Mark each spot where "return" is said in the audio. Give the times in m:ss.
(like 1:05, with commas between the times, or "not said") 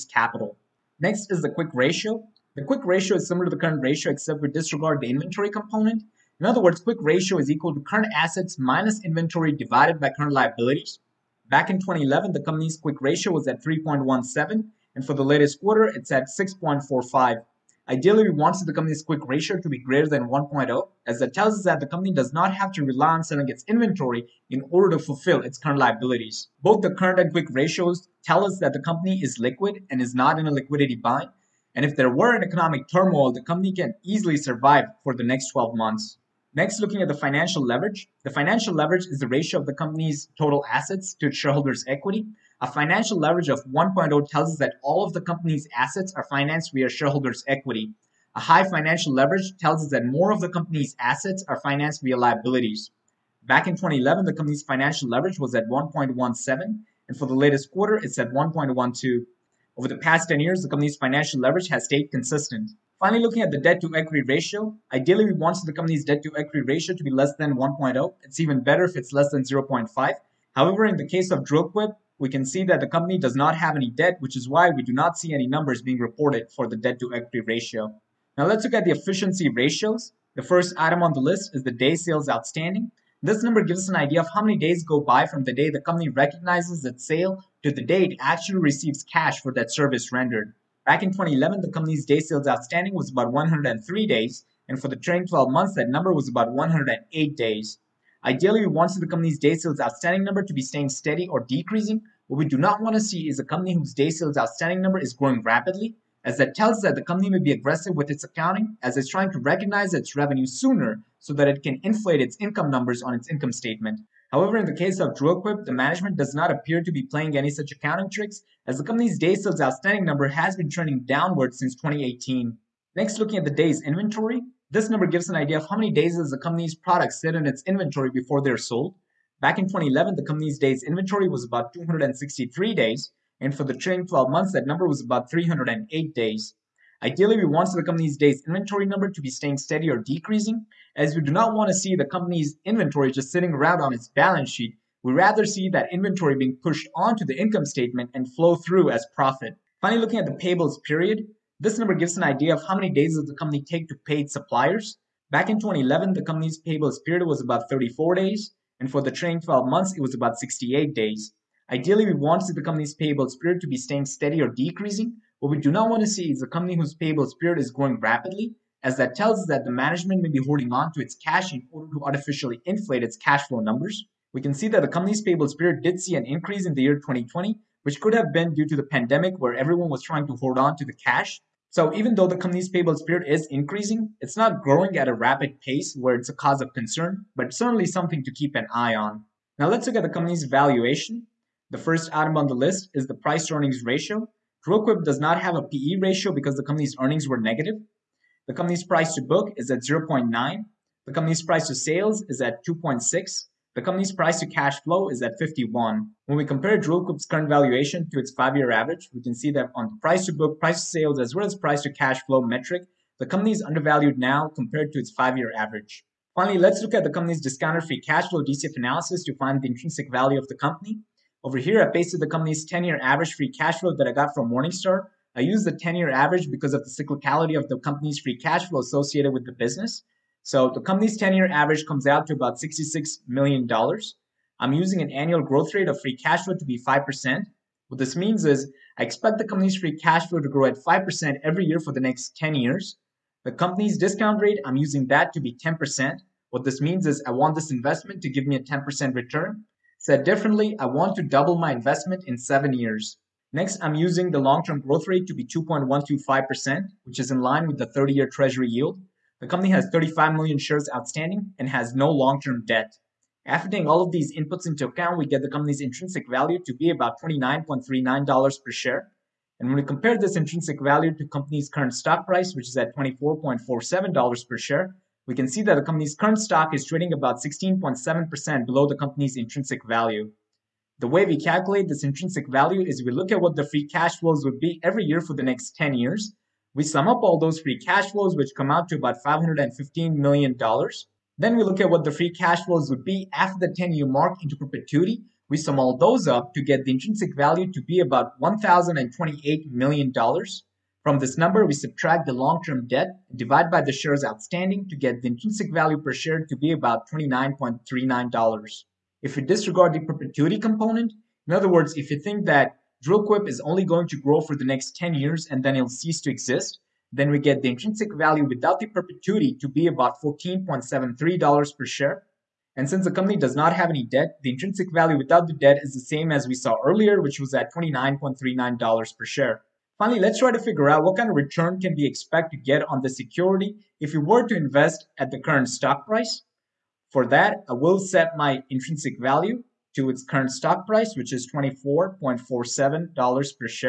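4:09, 5:31.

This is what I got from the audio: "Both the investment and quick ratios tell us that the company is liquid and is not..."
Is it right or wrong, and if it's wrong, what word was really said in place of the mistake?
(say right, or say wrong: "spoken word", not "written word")
wrong: "current", not "investment".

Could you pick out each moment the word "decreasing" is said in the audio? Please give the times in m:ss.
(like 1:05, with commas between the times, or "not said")
1:41, 2:19, 2:44.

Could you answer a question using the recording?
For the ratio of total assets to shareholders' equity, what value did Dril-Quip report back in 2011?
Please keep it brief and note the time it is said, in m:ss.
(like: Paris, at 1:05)
1.17, at 0:55.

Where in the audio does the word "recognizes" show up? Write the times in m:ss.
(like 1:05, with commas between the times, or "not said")
1:26, 1:49.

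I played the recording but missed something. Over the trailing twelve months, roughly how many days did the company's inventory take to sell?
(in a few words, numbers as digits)
308 days.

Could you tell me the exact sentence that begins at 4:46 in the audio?
We sum up all those free cash flows, which come out to about $515 million.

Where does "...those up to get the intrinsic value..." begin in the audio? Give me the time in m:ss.
4:55.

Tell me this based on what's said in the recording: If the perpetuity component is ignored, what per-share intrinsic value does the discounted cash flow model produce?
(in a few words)
$14.73.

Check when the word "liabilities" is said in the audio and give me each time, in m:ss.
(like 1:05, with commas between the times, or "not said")
0:10, 0:25, 0:52.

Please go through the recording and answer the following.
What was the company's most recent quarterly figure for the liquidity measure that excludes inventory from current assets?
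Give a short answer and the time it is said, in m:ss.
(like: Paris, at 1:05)
6.45, at 0:16.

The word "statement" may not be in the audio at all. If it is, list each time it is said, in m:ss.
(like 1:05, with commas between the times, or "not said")
1:53, 2:27.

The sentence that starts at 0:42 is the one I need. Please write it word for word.
A financial leverage of 1.0 tells us that all of the company's assets are financed via shareholders' equity.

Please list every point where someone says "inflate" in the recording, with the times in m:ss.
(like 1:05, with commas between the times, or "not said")
1:51, 2:52.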